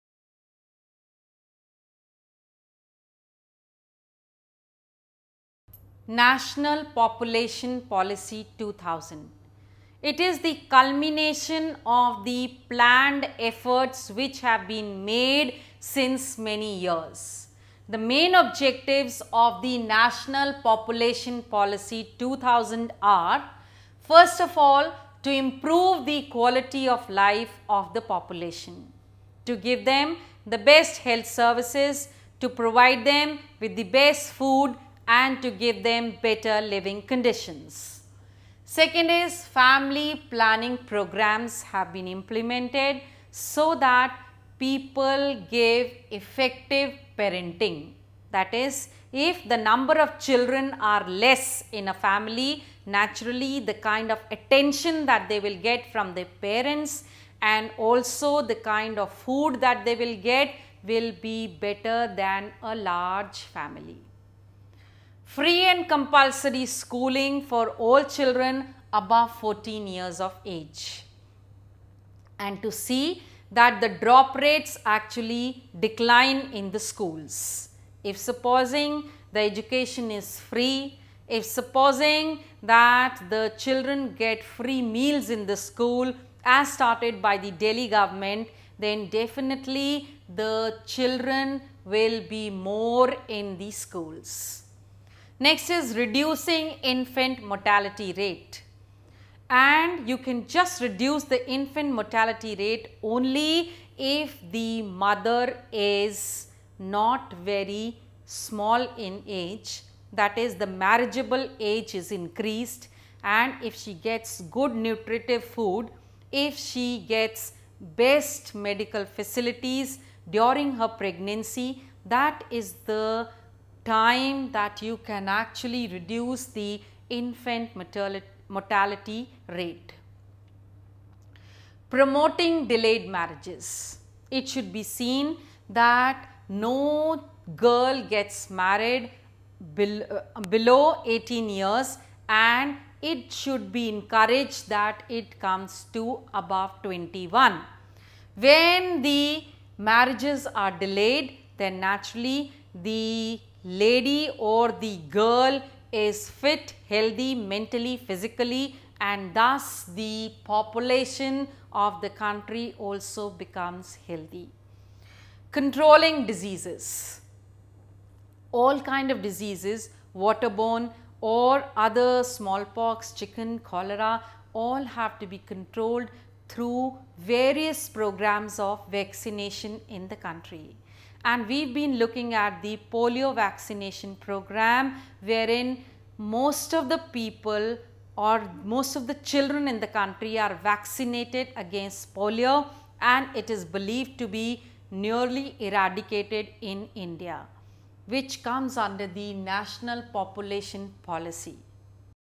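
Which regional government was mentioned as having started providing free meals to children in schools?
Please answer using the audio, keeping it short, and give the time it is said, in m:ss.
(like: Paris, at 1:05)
Delhi, at 1:27.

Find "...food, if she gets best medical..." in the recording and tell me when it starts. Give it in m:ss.
1:55.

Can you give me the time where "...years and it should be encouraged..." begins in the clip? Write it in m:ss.
2:21.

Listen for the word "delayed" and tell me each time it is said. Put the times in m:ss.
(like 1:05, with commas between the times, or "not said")
2:12, 2:30.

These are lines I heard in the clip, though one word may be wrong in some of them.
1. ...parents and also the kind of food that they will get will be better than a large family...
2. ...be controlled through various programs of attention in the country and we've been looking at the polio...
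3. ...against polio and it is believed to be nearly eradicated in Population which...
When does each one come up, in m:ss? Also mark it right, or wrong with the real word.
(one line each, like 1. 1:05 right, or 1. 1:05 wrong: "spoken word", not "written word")
1. 0:56 right
2. 2:55 wrong: "vaccination", not "attention"
3. 3:11 wrong: "India", not "Population".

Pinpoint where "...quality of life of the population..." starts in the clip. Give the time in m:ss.
0:26.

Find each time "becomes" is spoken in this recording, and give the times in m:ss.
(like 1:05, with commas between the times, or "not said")
2:43.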